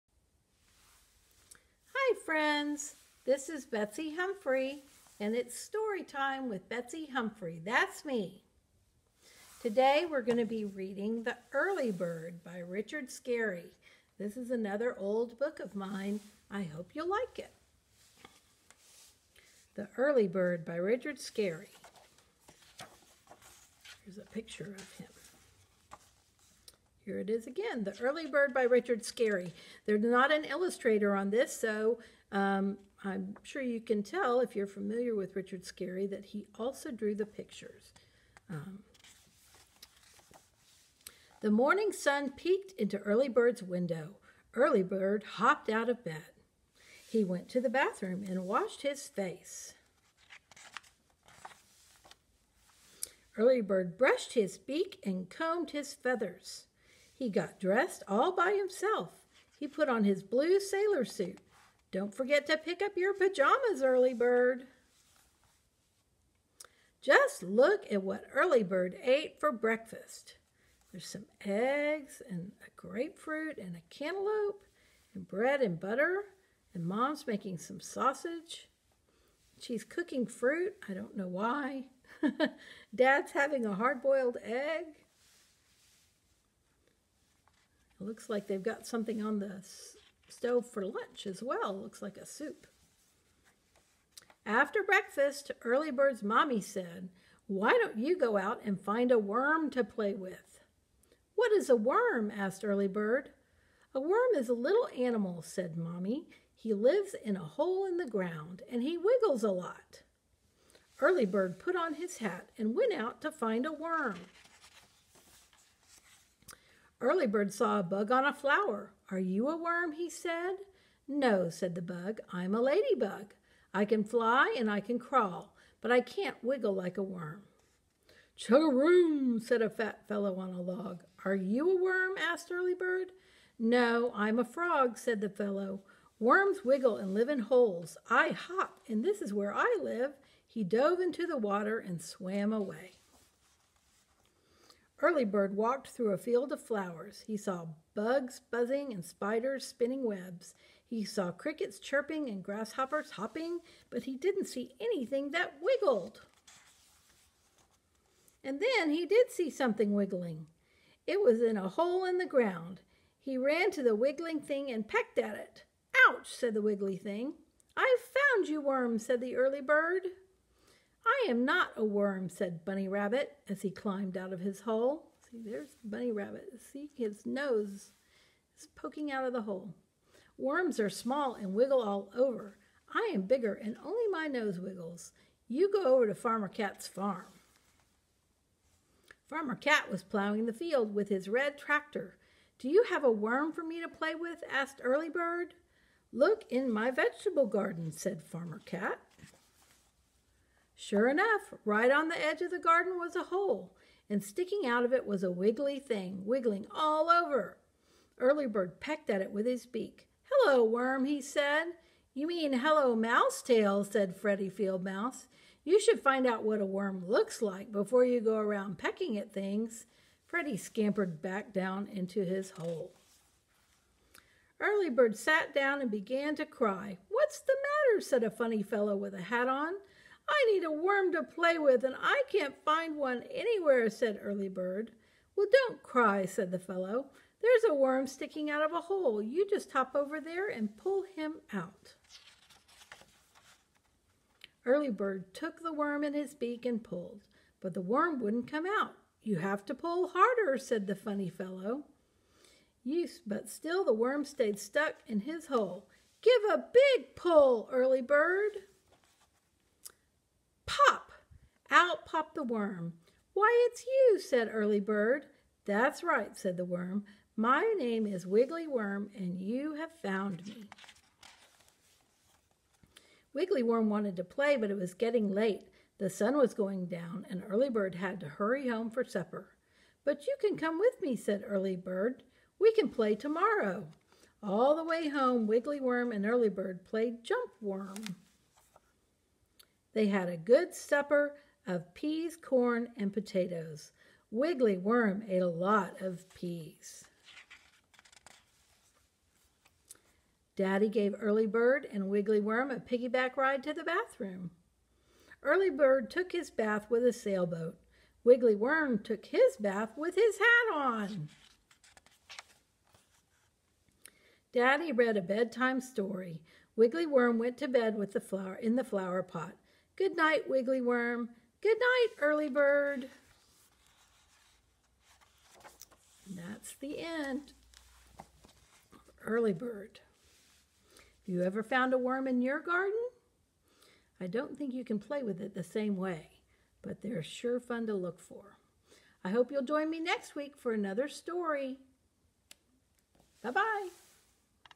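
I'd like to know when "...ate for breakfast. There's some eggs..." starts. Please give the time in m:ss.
1:09.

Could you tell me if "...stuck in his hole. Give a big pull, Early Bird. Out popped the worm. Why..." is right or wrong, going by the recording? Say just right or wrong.
right.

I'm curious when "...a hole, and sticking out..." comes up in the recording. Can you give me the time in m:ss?
3:23.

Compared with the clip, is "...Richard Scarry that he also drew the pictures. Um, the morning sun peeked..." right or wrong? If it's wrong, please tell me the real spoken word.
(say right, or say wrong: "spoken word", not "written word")
right.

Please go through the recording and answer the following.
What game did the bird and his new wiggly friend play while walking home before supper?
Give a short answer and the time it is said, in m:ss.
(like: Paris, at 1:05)
Jump Worm, at 4:47.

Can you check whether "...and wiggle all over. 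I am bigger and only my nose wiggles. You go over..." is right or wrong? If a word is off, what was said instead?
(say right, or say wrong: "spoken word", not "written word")
right.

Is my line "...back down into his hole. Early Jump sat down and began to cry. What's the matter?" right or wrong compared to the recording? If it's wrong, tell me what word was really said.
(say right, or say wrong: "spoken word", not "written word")
wrong: "Bird", not "Jump".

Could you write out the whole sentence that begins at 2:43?
He ran to the wiggling thing and pecked at it.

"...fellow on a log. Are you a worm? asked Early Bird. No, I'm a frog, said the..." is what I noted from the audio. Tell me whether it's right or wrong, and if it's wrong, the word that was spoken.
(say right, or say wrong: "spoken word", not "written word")
right.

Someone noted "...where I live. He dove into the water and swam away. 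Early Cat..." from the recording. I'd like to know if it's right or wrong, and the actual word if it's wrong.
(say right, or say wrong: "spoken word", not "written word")
wrong: "Bird", not "Cat".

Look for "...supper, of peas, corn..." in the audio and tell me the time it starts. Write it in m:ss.
4:50.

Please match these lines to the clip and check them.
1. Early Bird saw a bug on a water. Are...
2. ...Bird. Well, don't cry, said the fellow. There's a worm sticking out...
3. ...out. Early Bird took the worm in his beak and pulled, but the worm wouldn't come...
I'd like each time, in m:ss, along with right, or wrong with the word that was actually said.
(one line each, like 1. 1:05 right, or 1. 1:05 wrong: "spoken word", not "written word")
1. 1:57 wrong: "flower", not "water"
2. 3:54 right
3. 4:01 right.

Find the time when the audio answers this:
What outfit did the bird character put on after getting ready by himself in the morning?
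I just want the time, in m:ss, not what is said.
1:00.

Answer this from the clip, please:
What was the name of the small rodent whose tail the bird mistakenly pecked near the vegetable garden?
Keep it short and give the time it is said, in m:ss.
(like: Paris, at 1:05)
Freddie Field Mouse, at 3:34.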